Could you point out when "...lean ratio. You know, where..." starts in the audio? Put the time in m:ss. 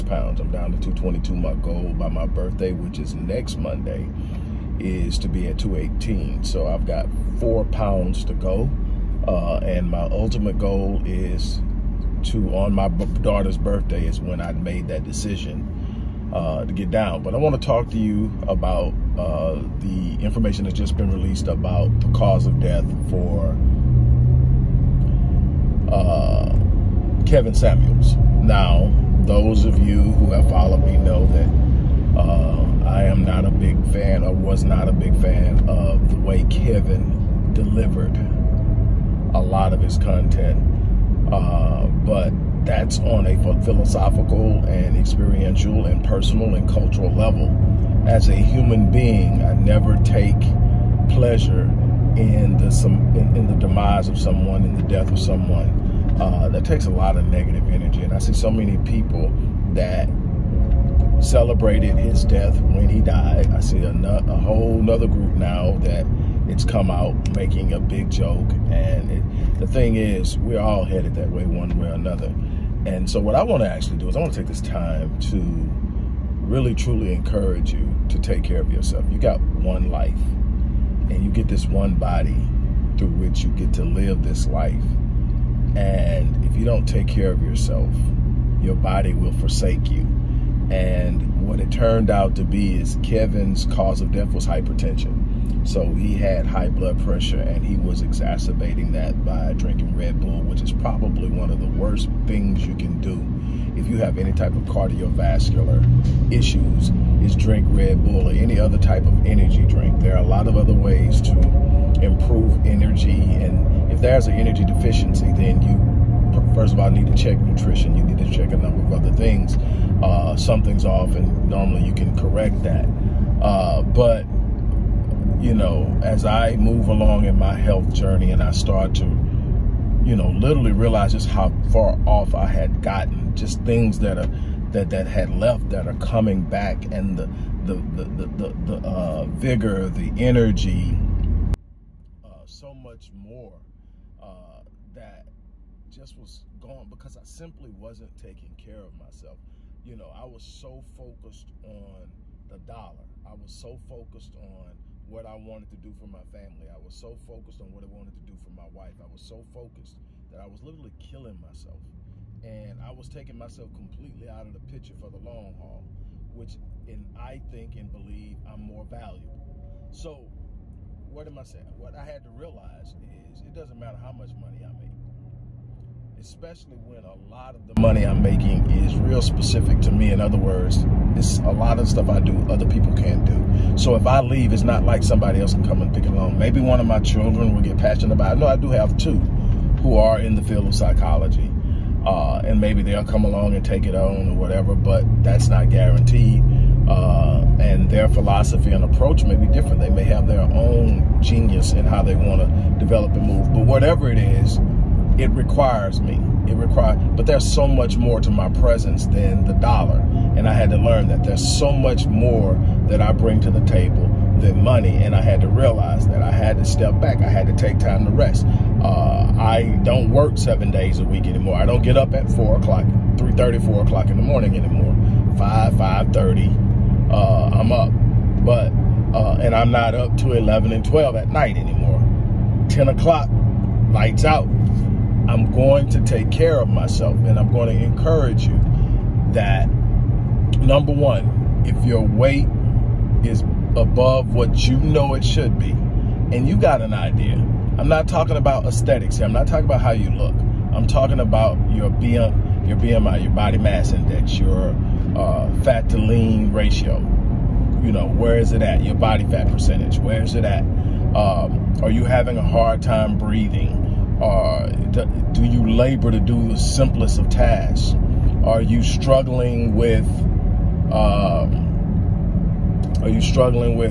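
4:15.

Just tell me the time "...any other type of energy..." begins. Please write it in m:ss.
1:48.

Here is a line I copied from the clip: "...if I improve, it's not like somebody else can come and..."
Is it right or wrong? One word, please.
wrong.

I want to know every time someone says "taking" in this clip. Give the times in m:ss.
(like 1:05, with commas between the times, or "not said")
2:28, 2:43.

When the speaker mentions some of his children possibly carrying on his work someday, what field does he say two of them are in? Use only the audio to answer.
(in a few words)
psychology.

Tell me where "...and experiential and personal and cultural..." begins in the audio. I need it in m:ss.
0:44.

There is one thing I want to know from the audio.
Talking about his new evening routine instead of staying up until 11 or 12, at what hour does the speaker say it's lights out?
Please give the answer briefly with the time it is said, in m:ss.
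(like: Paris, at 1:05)
10 o'clock, at 3:52.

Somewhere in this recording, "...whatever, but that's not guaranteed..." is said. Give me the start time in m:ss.
3:14.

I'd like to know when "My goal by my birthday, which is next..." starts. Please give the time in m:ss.
0:01.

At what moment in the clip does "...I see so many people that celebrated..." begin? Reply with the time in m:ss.
0:58.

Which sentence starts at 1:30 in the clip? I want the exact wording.
And what it turned out to be is Kevin's cause of death was hypertension.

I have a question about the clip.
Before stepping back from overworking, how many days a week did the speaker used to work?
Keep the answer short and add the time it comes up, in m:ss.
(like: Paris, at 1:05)
7, at 3:40.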